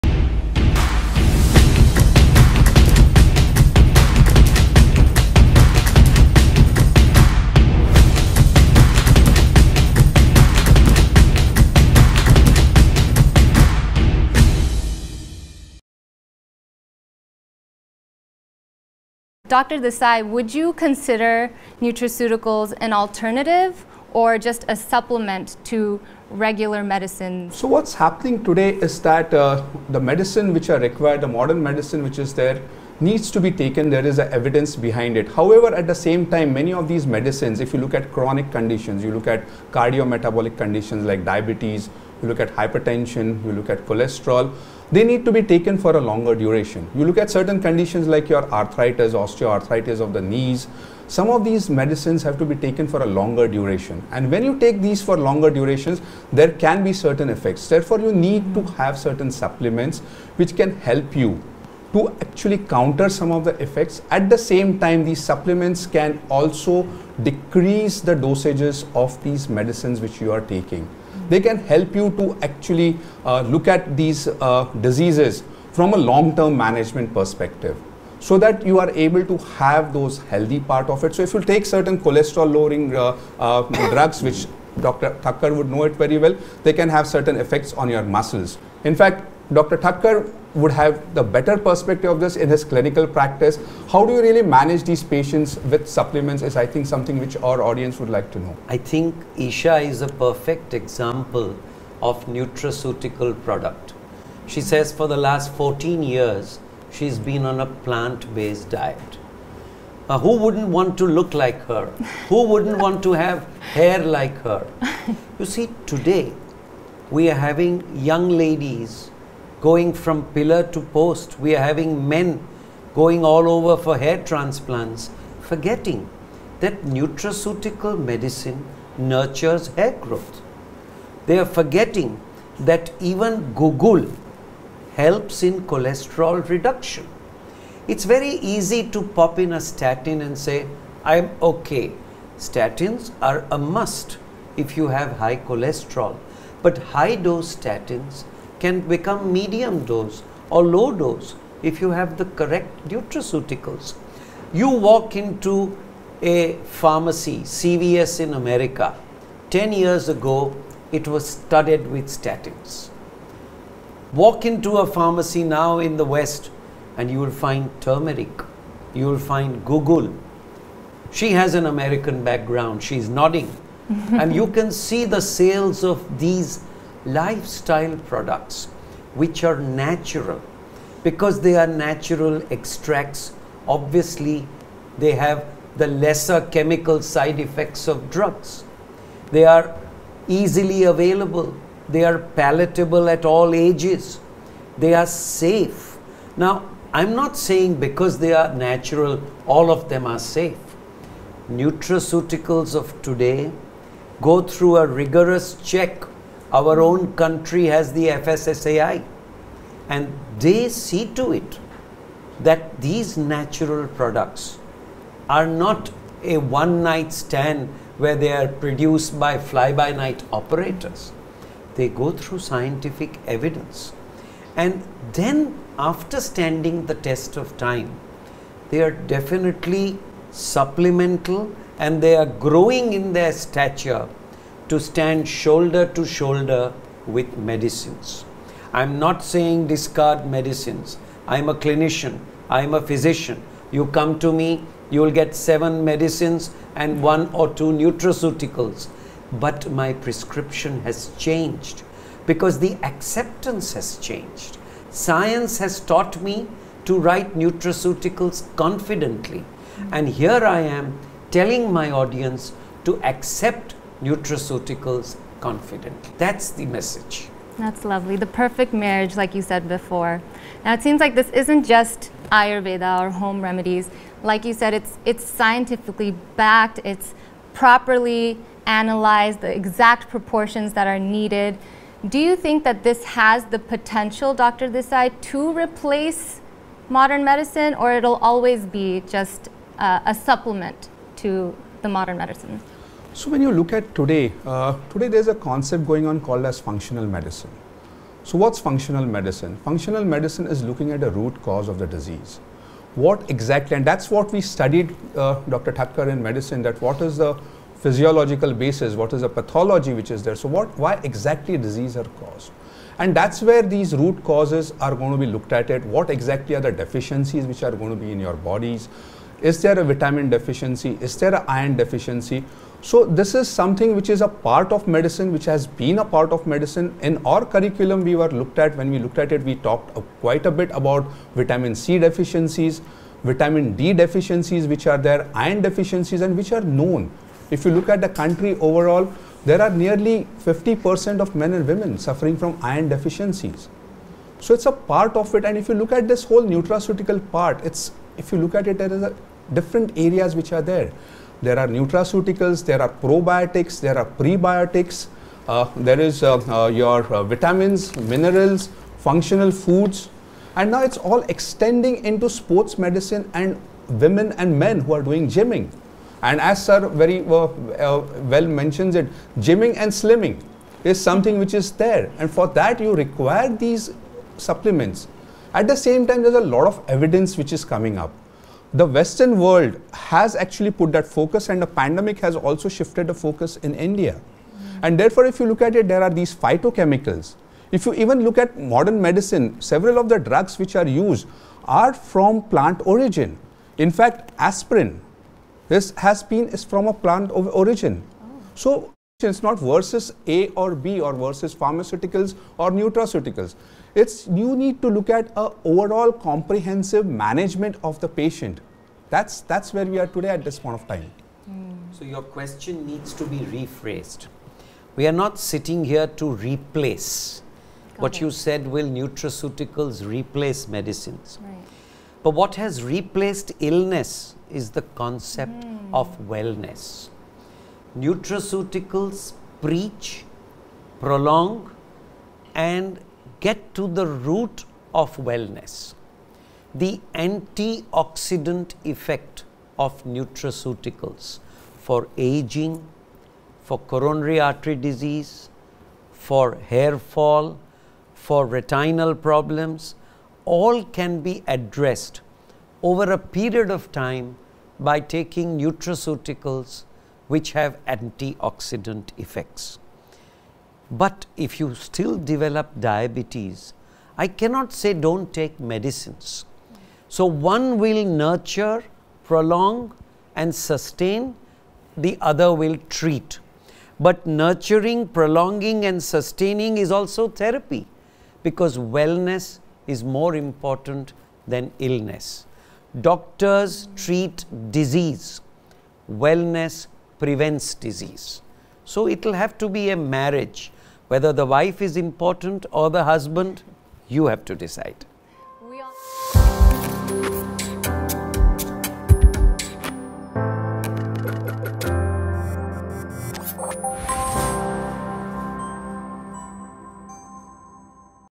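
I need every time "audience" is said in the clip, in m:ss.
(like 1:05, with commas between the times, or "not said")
1:37, 4:21.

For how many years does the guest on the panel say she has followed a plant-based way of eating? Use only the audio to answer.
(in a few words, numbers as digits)
14 years.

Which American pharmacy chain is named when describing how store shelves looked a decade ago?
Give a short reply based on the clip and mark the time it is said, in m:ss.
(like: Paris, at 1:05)
CVS, at 2:37.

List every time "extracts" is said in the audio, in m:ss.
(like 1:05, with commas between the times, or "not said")
3:02.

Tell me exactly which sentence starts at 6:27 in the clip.
If you even look at modern medicine, several of the drugs which are used are from plant origin.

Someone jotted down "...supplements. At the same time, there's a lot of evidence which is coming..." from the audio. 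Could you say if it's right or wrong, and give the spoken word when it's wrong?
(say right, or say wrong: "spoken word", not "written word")
right.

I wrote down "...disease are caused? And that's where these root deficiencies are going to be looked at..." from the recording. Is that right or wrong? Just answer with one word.
wrong.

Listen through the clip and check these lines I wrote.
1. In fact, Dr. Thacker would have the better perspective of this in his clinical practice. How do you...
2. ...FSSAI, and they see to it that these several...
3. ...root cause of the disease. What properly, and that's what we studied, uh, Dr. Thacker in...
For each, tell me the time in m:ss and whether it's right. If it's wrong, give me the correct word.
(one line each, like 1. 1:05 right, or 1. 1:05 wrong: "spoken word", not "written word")
1. 1:28 right
2. 3:28 wrong: "natural", not "several"
3. 5:01 wrong: "exactly", not "properly".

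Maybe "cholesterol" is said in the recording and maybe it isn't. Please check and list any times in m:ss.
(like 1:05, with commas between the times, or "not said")
0:43, 1:21, 2:15, 2:25.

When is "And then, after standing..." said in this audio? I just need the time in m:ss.
3:44.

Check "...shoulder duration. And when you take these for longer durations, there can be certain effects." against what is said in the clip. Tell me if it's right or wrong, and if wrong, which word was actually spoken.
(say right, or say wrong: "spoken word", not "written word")
wrong: "longer", not "shoulder".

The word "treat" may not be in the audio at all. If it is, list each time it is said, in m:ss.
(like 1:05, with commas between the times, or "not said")
7:52, 8:03.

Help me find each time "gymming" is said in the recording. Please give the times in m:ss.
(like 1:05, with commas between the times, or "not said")
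6:05, 6:09.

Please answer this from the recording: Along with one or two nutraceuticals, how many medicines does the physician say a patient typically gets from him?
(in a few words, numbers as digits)
7.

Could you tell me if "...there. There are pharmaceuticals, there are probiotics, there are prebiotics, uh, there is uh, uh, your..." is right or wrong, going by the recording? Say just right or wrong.
wrong.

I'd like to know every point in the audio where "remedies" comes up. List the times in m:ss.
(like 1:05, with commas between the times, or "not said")
4:33.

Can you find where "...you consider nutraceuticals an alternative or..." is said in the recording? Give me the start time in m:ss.
0:20.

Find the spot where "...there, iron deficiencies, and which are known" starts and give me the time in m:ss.
5:34.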